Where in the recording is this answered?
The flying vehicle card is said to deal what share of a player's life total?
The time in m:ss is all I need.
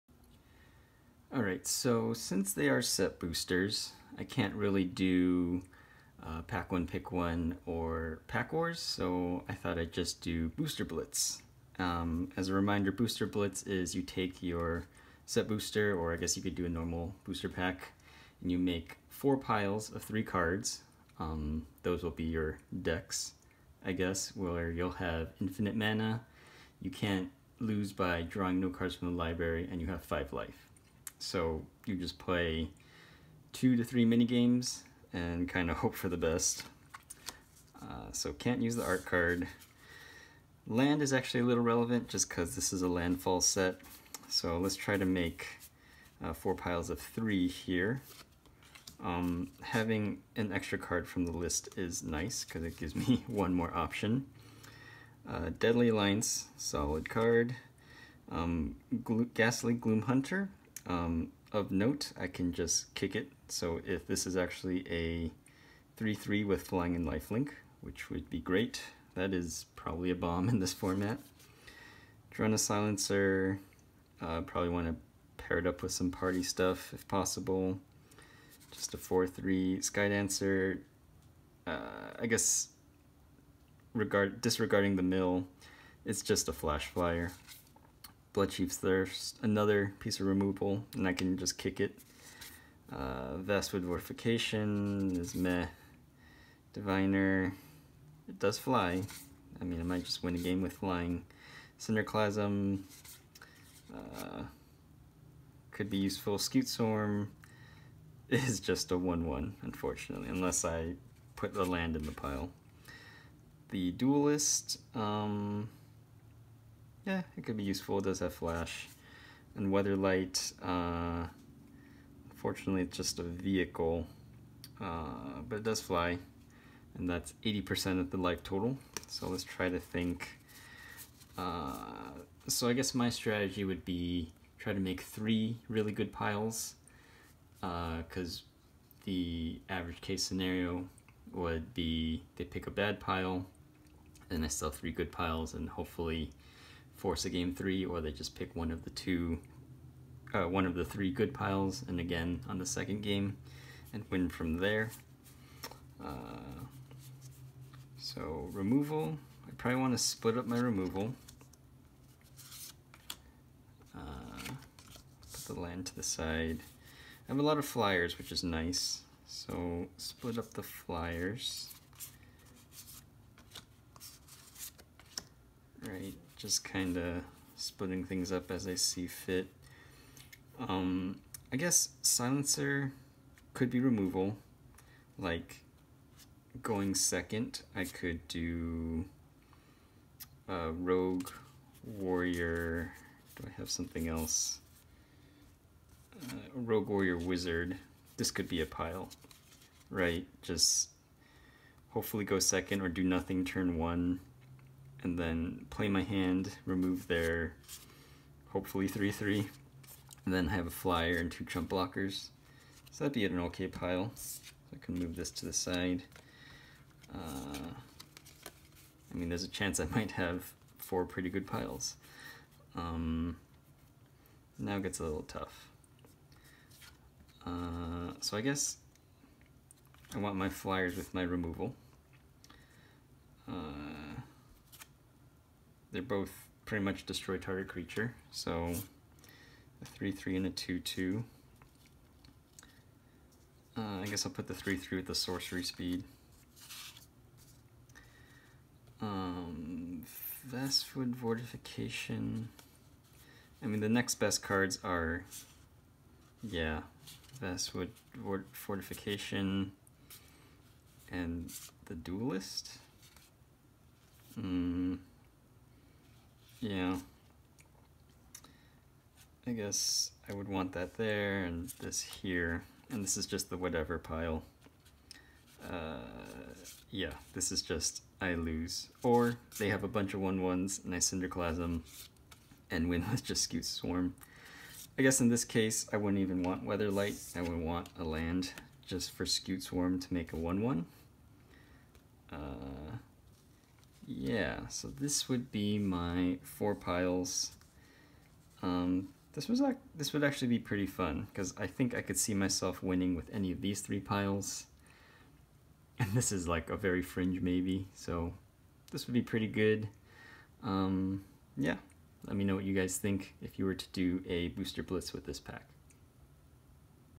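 2:07.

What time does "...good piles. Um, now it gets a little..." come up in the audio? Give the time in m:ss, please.
3:41.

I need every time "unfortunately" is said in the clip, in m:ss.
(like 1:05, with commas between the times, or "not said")
1:49, 2:02.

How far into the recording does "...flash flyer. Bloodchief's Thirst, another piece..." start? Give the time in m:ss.
1:26.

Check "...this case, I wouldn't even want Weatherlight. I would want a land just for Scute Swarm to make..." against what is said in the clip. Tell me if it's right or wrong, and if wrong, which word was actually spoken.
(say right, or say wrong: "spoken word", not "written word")
right.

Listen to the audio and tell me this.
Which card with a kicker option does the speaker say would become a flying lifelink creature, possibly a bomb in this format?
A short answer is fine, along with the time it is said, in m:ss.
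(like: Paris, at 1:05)
Ghastly Gloomhunter, at 0:59.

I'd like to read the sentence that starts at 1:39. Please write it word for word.
I mean, I might just win a game with flying.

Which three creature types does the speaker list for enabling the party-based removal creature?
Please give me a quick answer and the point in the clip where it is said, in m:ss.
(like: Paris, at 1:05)
Rogue, warrior, wizard, at 3:16.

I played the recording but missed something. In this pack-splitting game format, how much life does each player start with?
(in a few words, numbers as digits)
5.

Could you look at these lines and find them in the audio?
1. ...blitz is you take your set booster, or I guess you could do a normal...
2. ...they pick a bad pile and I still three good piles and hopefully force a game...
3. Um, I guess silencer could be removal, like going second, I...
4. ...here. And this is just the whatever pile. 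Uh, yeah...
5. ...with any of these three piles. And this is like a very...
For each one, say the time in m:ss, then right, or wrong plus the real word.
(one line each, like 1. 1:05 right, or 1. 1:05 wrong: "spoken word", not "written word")
1. 0:13 right
2. 2:22 right
3. 3:00 right
4. 4:32 right
5. 5:03 right.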